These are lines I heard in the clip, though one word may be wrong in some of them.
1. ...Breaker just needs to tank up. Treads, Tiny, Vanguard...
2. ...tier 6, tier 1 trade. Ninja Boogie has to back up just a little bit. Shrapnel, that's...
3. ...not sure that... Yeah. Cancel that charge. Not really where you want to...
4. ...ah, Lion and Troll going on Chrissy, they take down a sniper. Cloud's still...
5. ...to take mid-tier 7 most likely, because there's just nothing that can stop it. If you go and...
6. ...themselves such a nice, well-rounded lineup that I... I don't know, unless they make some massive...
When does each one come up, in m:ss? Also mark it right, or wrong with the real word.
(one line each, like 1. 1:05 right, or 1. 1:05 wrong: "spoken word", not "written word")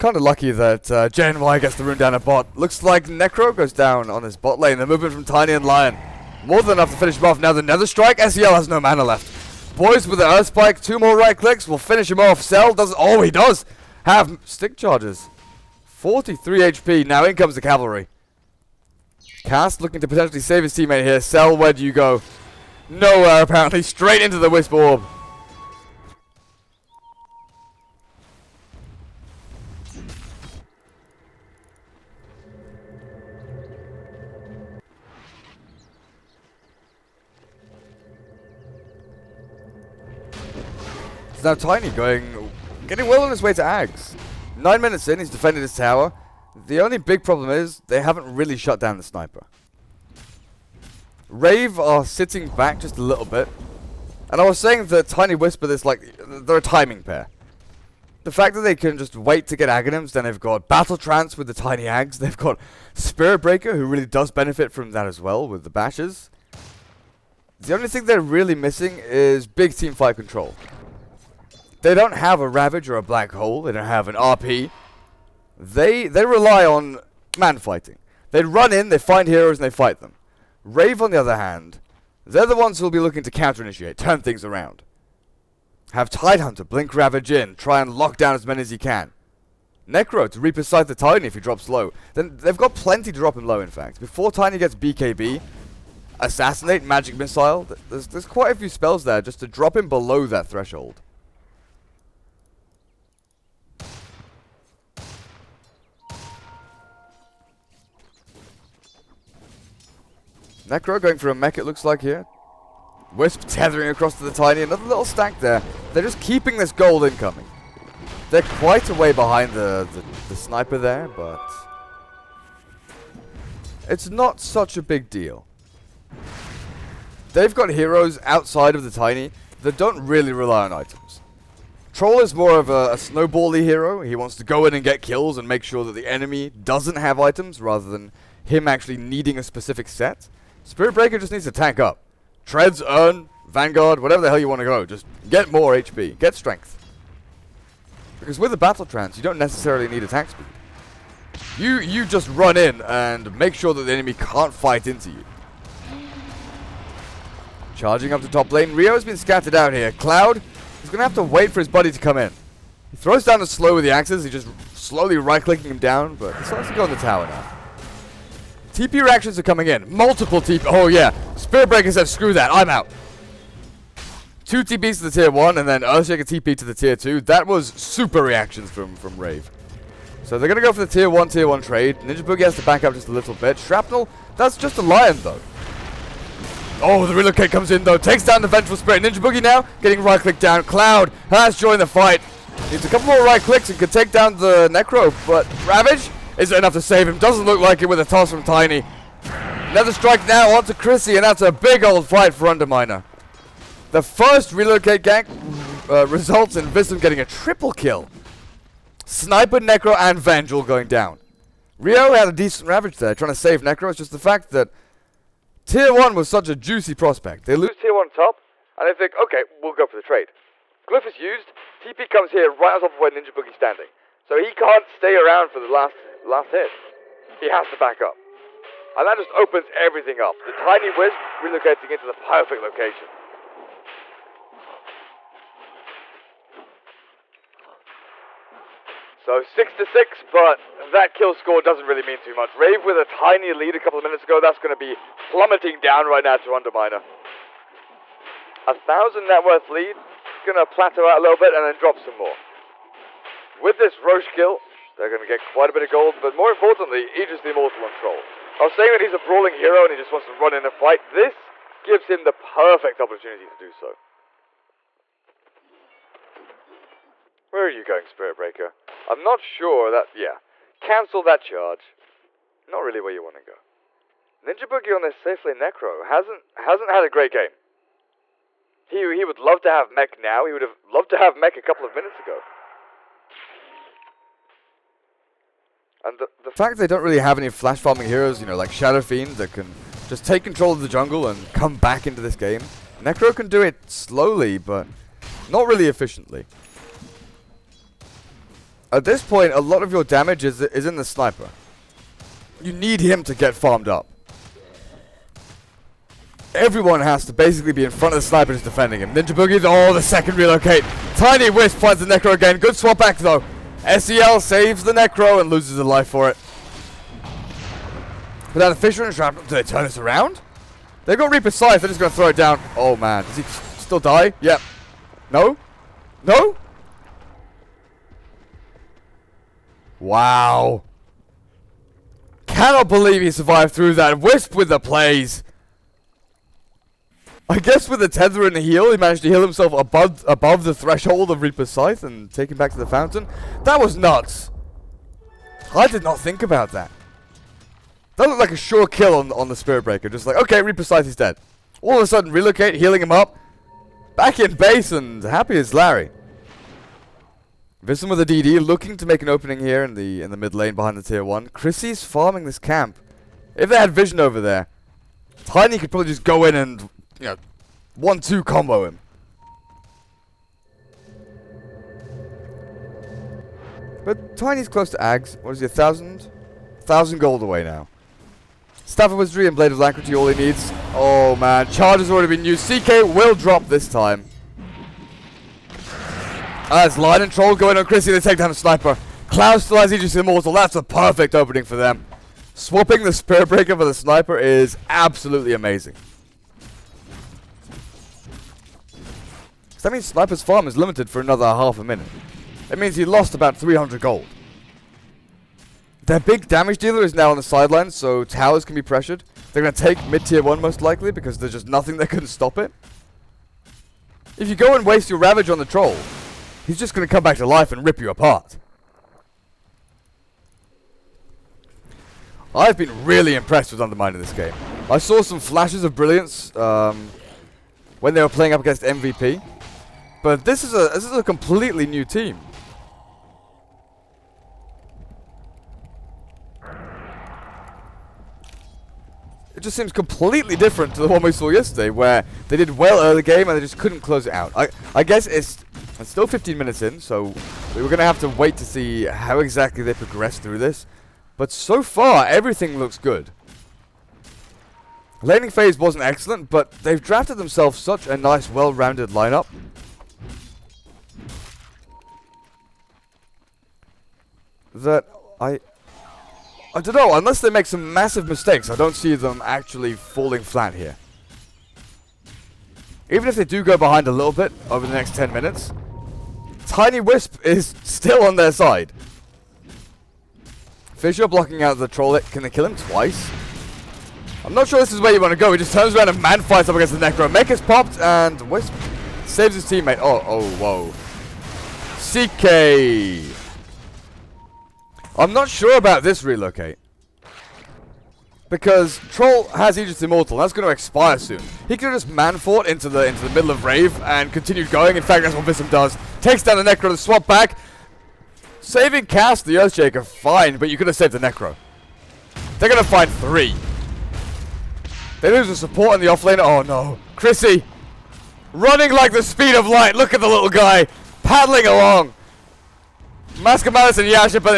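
1. 2:20 wrong: "Urn", not "Tiny"
2. 3:00 wrong: "1", not "6"
3. 4:29 right
4. 6:26 right
5. 6:49 wrong: "1", not "7"
6. 7:37 right.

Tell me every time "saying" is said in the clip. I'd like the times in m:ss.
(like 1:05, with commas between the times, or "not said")
0:54, 4:18.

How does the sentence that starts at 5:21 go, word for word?
They've got Reaper's Scythe, they're just going to throw it down.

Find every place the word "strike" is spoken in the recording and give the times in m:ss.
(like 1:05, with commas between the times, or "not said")
0:07, 3:19.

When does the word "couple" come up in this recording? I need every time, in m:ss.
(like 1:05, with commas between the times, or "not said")
3:12, 4:03, 4:41.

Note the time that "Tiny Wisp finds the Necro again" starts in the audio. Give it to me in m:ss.
5:11.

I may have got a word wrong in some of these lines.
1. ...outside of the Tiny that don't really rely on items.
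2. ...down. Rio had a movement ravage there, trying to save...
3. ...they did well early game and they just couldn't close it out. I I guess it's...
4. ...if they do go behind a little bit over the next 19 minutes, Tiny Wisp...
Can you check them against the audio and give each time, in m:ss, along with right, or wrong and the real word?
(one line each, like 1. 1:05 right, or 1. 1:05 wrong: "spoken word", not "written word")
1. 2:08 right
2. 3:30 wrong: "decent", not "movement"
3. 7:22 right
4. 7:53 wrong: "10", not "19".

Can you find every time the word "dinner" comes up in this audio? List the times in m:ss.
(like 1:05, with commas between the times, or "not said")
not said.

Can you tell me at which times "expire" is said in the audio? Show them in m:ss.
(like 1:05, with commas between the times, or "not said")
8:20.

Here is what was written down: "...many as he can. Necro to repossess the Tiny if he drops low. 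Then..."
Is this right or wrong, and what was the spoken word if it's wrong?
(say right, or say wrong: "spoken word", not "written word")
right.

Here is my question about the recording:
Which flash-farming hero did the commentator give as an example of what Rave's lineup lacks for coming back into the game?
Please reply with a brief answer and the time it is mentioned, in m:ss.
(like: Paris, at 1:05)
Shadow Fiend, at 4:48.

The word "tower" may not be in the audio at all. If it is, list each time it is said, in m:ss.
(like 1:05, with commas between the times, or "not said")
0:45, 2:46, 6:48.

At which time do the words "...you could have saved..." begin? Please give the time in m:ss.
8:30.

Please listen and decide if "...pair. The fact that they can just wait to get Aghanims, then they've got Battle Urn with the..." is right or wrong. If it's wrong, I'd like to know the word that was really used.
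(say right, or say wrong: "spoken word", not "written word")
wrong: "Trance", not "Urn".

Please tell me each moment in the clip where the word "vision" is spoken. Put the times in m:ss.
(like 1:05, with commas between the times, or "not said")
5:57, 6:03.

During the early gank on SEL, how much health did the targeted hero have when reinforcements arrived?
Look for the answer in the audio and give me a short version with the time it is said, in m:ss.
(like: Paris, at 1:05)
43 HP, at 0:15.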